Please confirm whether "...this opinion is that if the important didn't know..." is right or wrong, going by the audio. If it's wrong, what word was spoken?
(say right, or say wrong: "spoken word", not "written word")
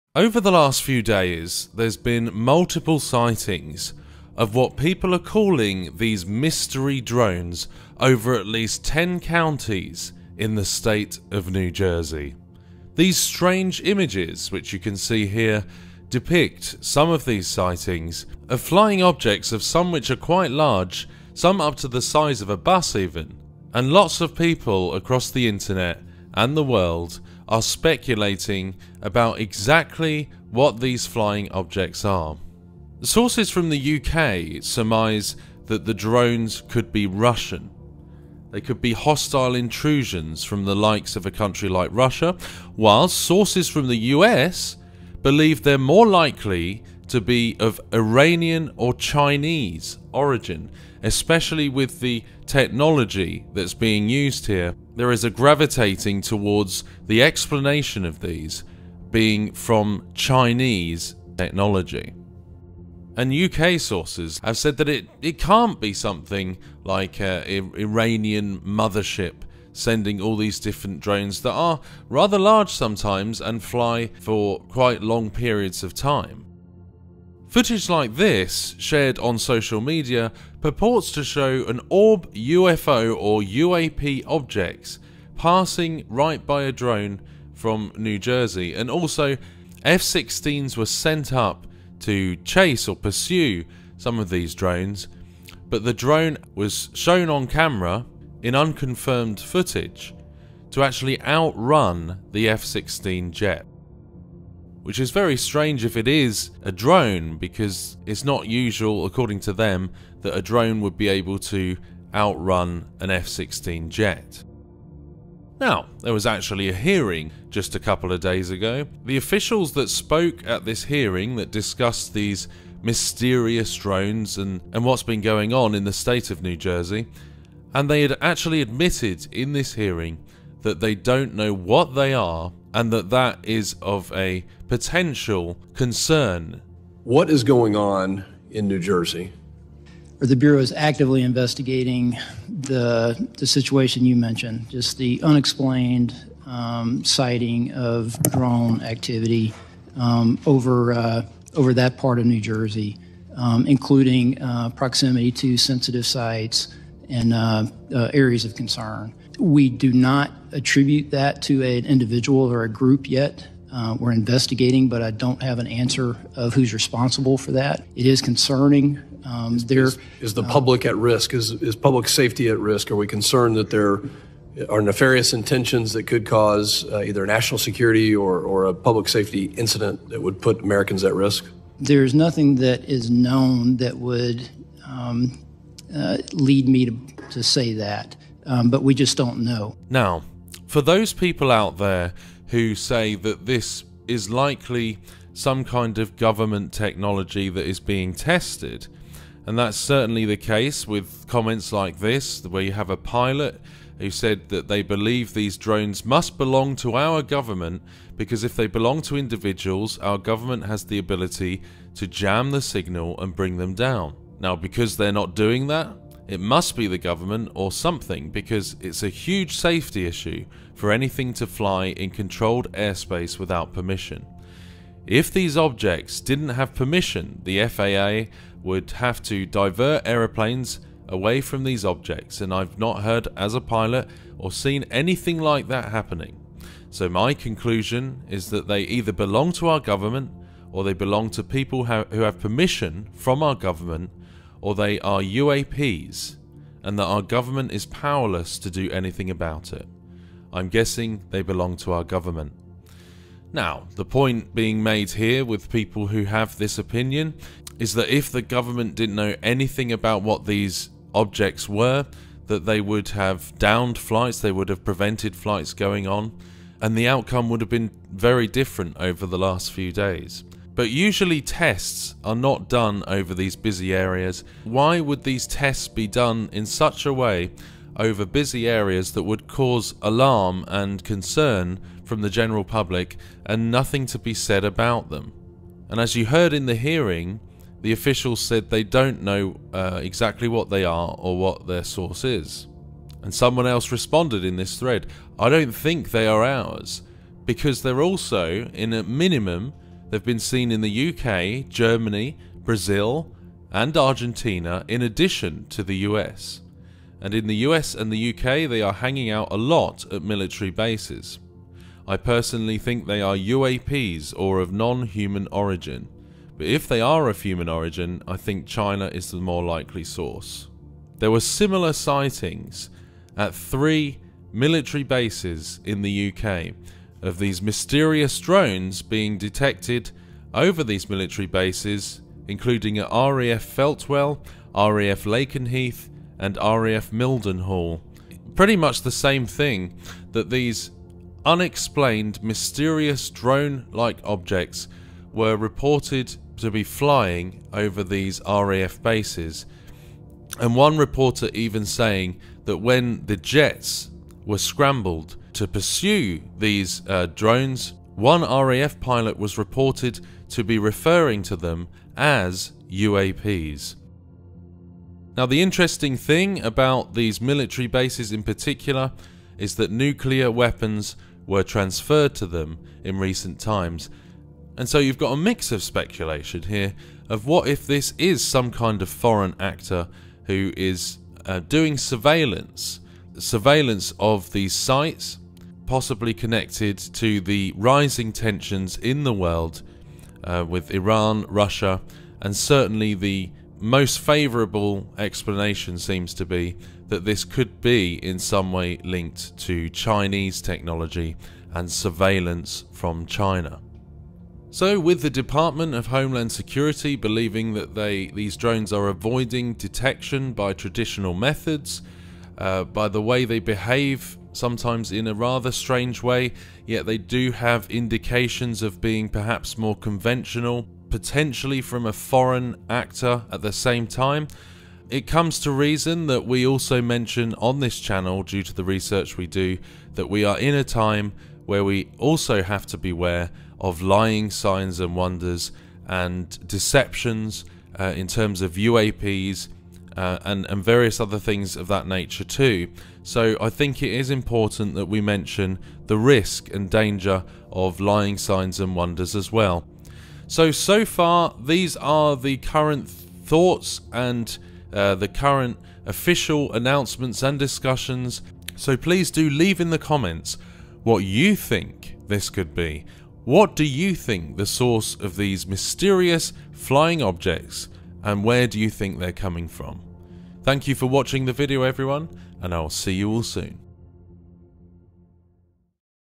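wrong: "government", not "important".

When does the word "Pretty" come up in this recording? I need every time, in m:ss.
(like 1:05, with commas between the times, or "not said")
5:38.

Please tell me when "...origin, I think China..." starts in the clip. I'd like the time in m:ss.
5:17.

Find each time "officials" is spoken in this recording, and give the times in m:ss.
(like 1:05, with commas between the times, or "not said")
1:59, 4:47, 7:36.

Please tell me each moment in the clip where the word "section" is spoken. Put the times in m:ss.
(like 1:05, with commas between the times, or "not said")
not said.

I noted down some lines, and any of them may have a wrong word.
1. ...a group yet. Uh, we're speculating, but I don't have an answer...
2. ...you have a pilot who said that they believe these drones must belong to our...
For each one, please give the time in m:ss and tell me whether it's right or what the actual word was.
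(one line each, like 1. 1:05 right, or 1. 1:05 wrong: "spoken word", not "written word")
1. 2:42 wrong: "investigating", not "speculating"
2. 3:22 right.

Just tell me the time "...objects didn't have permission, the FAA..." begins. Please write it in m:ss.
3:45.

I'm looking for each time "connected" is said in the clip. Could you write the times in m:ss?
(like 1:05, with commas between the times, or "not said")
6:26.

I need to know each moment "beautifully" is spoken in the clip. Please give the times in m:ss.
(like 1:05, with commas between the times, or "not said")
not said.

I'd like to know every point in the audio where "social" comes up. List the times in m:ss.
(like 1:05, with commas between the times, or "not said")
1:19.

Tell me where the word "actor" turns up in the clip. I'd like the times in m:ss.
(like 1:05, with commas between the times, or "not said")
6:19, 7:02.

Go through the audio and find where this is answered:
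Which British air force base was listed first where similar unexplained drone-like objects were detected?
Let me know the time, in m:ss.
5:33.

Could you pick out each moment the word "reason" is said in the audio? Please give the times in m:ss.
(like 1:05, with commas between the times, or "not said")
7:05.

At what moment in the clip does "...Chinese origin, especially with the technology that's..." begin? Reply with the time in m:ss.
0:48.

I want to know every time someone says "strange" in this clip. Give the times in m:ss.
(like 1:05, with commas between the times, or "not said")
0:13, 1:45, 6:55.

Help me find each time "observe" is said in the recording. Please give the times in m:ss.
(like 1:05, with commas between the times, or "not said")
not said.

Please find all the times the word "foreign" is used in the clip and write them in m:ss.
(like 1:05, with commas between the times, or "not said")
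6:19, 7:02.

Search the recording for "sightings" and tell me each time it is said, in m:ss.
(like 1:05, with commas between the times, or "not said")
0:02, 0:17, 2:27, 5:21.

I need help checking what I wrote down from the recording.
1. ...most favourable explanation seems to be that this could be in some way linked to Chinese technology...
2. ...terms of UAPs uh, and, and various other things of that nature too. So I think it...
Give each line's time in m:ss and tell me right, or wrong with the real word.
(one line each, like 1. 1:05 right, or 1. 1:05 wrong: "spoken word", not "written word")
1. 6:33 right
2. 7:18 right.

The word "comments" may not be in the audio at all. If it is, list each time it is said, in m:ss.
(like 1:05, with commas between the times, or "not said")
3:21, 7:39.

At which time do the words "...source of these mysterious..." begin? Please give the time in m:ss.
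7:44.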